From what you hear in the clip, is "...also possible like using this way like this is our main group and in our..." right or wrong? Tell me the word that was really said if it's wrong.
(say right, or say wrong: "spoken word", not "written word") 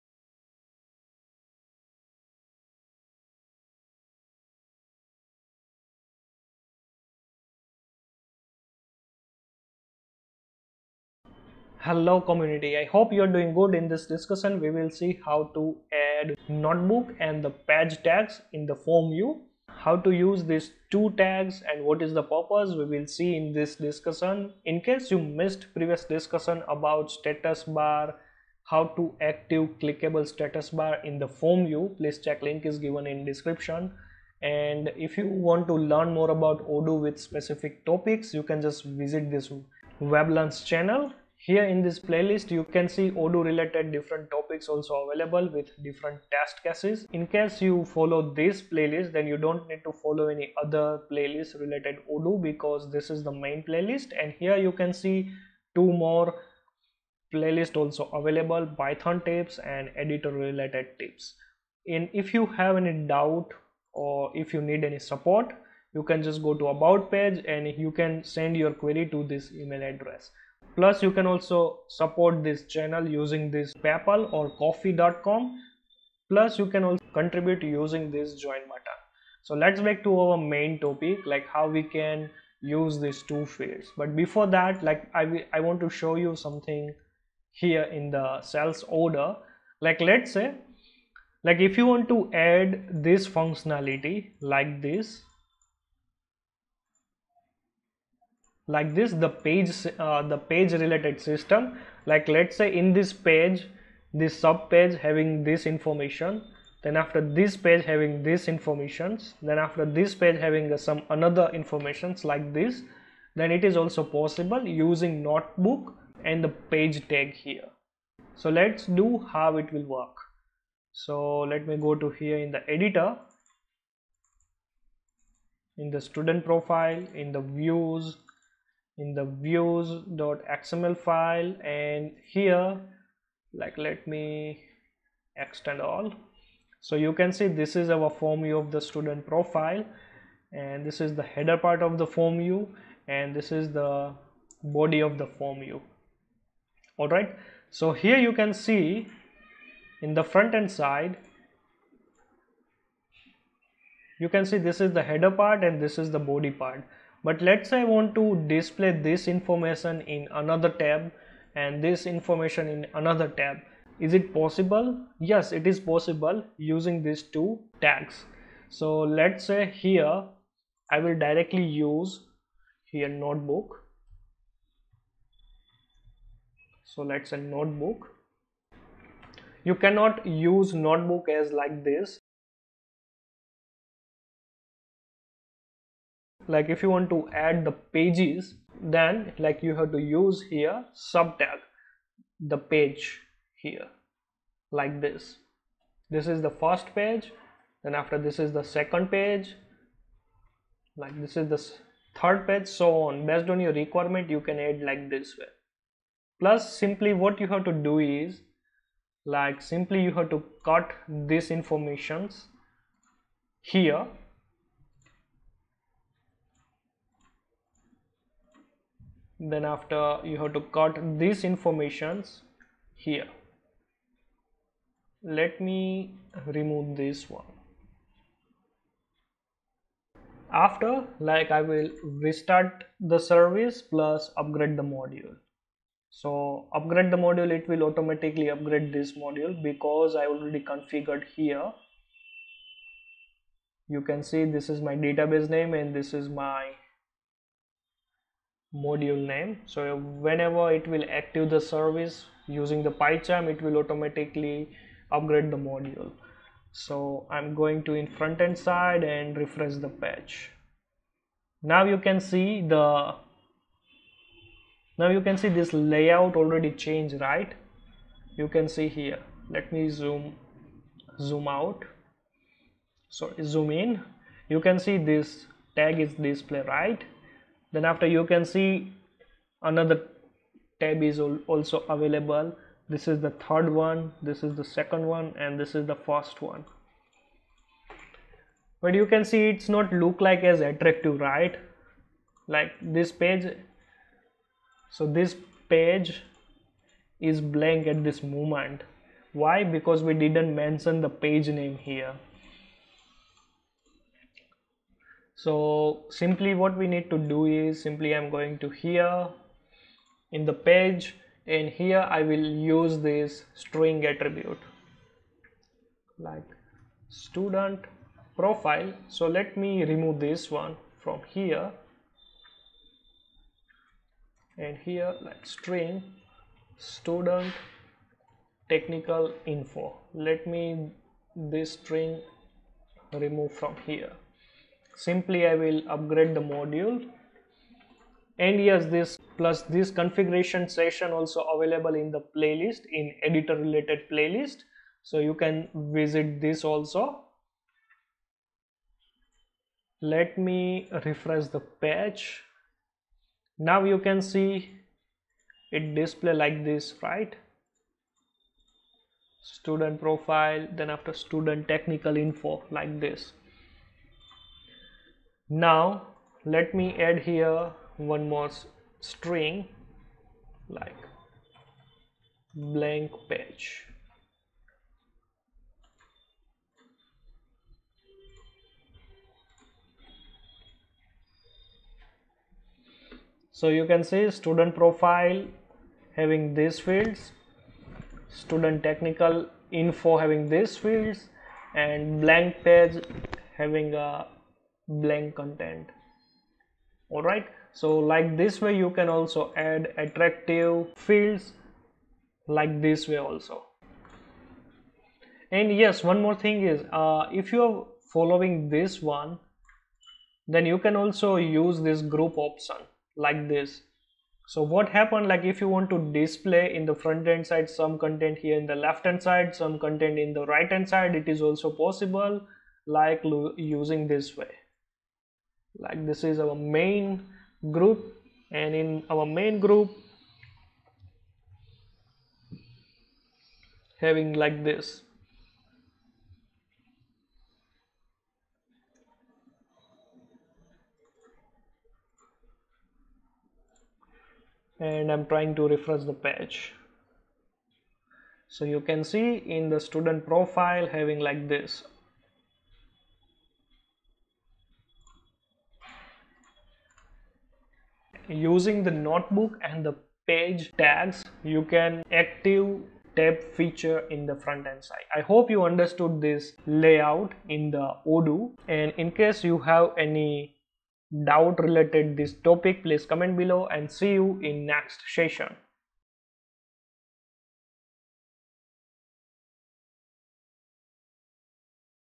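right.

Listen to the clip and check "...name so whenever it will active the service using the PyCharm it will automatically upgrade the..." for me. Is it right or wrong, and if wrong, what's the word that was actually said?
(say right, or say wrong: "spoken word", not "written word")
right.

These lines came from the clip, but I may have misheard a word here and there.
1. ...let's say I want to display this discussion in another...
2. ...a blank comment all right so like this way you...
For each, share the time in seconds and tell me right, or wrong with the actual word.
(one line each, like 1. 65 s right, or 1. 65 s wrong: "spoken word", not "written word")
1. 157 s wrong: "information", not "discussion"
2. 393 s wrong: "content", not "comment".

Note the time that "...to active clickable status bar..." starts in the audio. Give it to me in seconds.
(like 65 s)
28 s.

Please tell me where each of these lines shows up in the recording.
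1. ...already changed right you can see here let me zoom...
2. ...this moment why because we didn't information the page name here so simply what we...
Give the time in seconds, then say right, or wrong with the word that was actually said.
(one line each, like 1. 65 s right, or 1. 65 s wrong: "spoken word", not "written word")
1. 266 s right
2. 298 s wrong: "mention", not "information".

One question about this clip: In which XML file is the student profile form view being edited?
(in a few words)
views.xml.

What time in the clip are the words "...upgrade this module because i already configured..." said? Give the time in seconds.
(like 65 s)
238 s.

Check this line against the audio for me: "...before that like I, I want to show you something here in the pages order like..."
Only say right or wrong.
wrong.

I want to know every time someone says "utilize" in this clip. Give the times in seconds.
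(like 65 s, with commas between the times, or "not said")
not said.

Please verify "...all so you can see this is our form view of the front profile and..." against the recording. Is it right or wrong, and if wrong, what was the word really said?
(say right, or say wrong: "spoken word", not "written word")
wrong: "student", not "front".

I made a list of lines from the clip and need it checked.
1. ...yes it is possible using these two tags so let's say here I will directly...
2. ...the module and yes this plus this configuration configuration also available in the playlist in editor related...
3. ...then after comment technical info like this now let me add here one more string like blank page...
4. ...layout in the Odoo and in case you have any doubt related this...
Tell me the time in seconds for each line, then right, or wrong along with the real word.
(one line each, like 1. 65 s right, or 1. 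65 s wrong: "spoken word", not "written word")
1. 165 s right
2. 336 s wrong: "session", not "configuration"
3. 360 s wrong: "student", not "comment"
4. 466 s right.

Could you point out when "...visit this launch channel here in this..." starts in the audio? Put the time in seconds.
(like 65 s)
39 s.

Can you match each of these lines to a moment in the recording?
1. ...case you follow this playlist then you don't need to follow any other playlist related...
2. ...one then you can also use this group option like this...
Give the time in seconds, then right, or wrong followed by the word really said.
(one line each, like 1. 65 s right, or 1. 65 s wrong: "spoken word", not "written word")
1. 47 s right
2. 409 s right.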